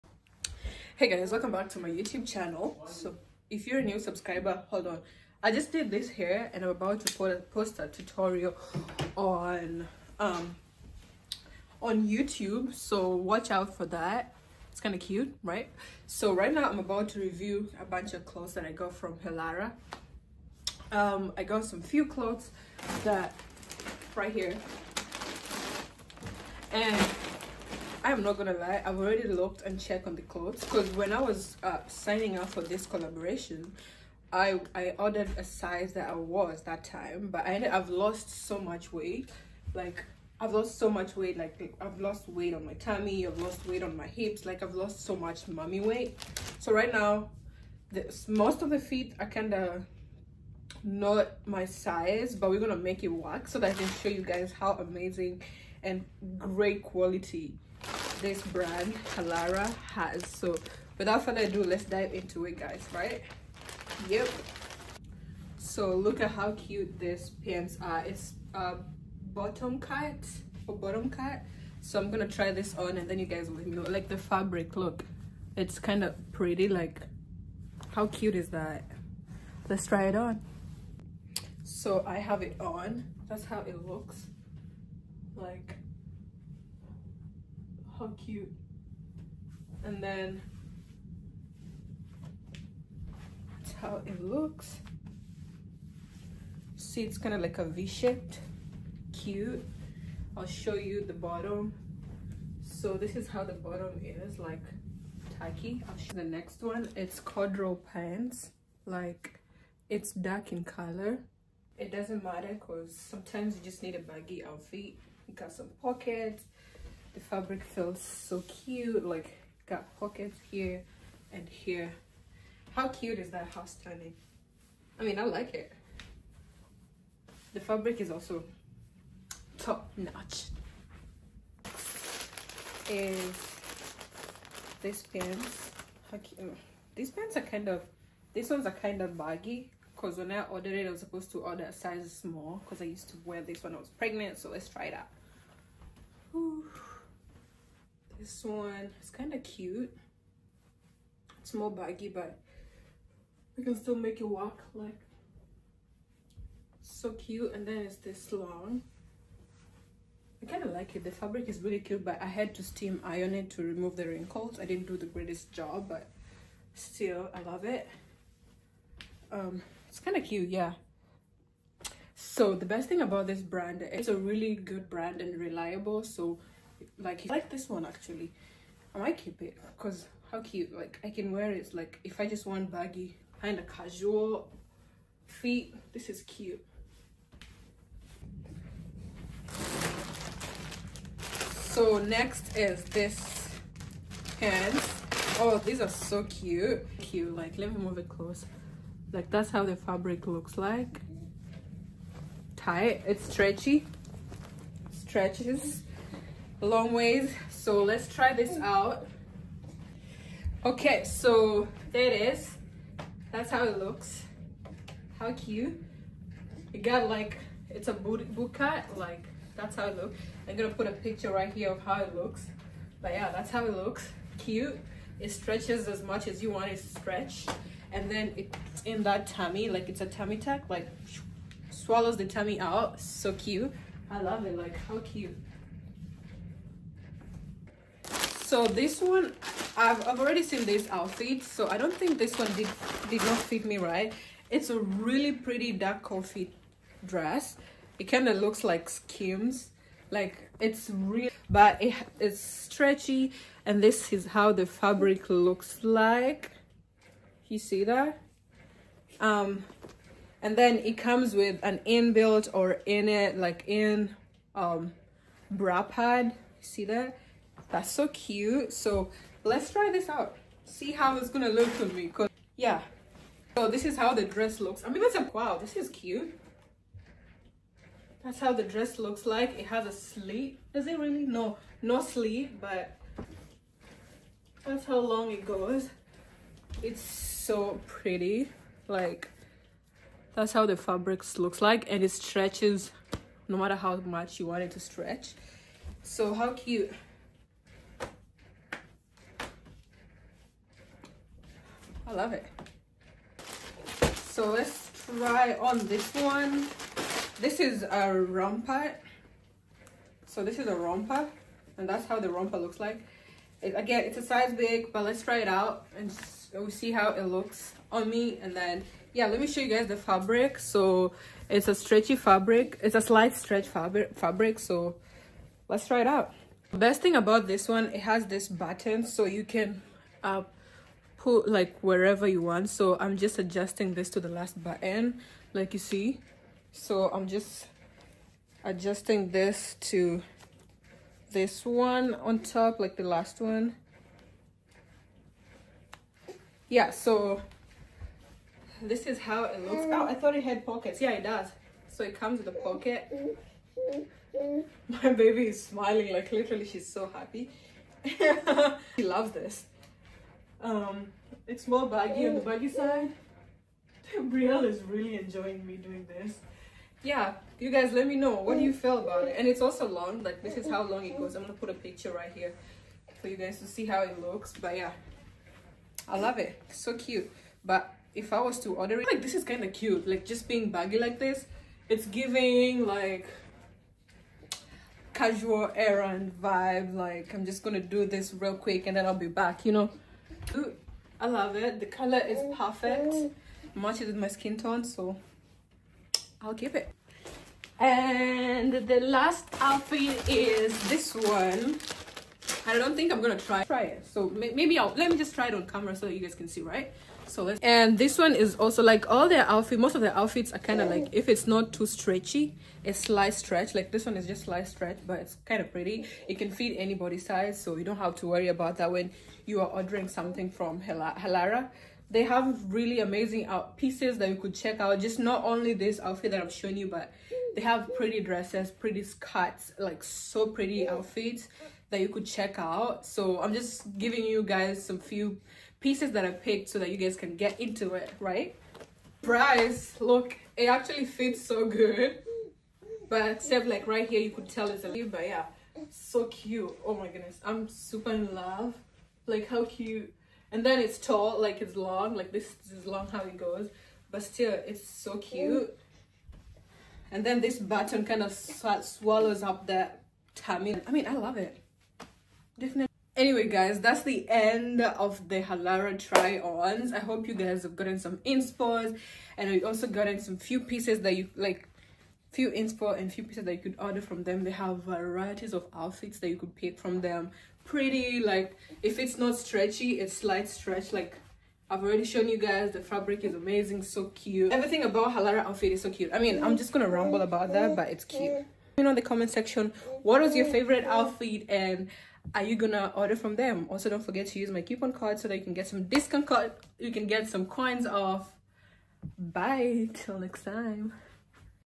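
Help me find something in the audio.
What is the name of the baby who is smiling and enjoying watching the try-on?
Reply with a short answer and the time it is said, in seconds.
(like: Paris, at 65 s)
Brielle, at 364 s.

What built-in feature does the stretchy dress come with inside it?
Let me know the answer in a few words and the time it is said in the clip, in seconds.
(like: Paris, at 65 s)
Bra pad, at 265 s.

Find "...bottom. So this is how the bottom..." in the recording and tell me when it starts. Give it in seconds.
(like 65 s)
101 s.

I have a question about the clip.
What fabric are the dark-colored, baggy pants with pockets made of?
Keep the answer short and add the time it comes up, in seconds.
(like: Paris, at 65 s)
Corduroy, at 107 s.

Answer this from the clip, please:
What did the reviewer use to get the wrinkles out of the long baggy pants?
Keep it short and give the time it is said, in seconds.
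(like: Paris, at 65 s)
Steam iron, at 162 s.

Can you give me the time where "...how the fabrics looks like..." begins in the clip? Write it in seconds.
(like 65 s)
290 s.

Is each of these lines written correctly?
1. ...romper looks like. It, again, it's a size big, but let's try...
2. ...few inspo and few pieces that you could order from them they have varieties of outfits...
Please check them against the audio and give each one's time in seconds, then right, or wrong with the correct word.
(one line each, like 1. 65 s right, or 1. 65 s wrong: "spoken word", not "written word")
1. 312 s right
2. 472 s right.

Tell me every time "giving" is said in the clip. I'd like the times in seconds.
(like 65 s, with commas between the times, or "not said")
382 s, 433 s.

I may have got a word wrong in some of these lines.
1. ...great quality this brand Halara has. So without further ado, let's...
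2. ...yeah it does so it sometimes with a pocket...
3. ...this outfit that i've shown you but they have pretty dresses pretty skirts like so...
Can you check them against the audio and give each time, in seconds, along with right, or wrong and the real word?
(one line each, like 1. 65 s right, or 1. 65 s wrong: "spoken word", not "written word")
1. 56 s right
2. 350 s wrong: "comes", not "sometimes"
3. 425 s right.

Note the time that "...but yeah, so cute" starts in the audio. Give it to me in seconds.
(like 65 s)
445 s.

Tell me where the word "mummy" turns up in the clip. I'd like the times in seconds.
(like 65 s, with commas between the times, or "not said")
45 s.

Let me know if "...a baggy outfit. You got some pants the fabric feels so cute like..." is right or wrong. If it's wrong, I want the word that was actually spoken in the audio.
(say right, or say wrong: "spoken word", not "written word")
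wrong: "pockets", not "pants".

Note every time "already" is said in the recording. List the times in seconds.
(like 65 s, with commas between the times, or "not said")
28 s, 240 s, 481 s.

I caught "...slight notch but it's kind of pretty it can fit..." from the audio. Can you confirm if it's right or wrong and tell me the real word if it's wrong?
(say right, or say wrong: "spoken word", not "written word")
wrong: "stretch", not "notch".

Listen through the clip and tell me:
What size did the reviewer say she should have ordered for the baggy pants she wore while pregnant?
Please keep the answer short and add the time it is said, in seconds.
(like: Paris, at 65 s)
Small, at 141 s.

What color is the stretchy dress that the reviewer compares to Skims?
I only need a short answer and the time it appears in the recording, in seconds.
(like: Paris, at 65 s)
Dark coffee, at 245 s.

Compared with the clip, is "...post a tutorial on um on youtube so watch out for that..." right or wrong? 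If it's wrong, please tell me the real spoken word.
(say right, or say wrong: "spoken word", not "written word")
right.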